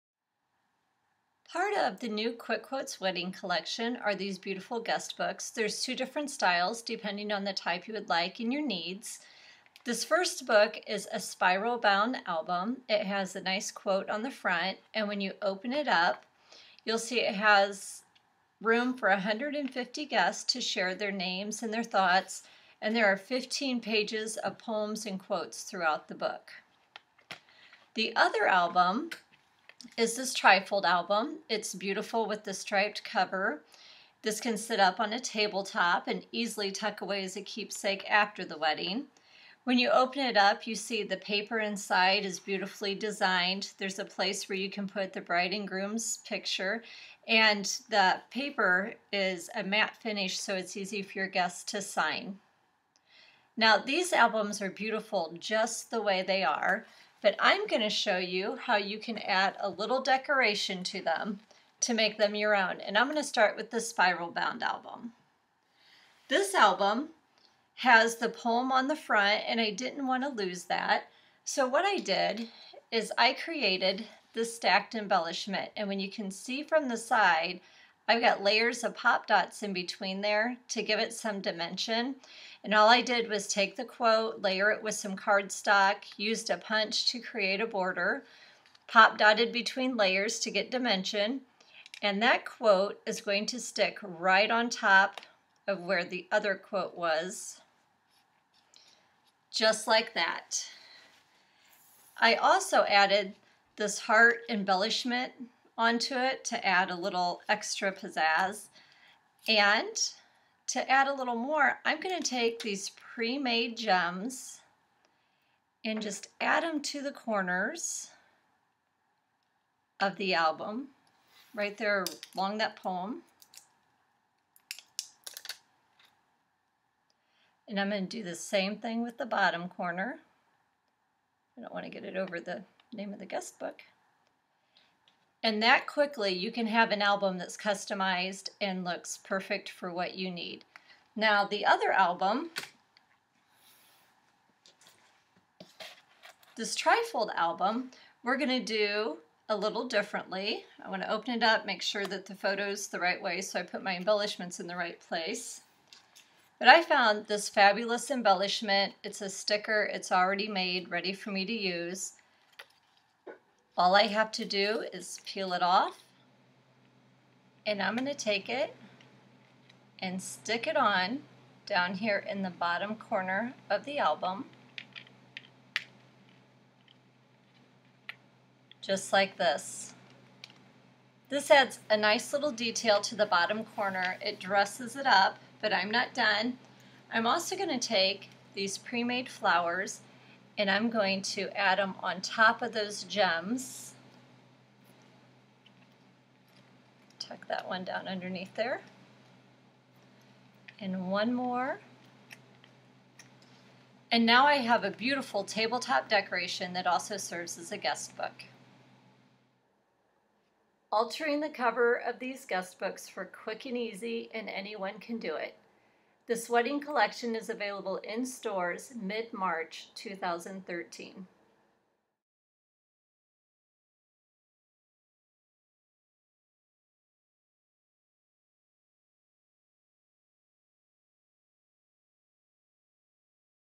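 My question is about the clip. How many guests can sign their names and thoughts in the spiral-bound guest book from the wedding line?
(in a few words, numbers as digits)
150.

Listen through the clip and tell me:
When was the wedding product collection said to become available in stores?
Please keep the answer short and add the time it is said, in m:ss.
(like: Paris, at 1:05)
Mid-March 2013, at 3:38.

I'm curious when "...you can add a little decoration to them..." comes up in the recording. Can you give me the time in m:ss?
0:58.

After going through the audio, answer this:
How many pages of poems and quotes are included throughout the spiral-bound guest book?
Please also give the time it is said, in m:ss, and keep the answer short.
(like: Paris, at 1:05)
15, at 0:23.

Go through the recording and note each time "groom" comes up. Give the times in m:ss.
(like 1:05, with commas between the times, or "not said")
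0:45.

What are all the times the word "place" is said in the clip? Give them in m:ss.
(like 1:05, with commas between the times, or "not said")
0:44, 2:34.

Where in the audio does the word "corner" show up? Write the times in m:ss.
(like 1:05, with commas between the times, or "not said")
1:57, 2:09, 2:52, 3:03.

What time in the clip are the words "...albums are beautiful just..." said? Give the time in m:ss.
0:54.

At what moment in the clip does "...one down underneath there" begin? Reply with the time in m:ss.
3:17.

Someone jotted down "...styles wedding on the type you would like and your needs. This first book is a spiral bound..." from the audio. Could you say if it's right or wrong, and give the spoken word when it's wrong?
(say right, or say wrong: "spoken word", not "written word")
wrong: "depending", not "wedding".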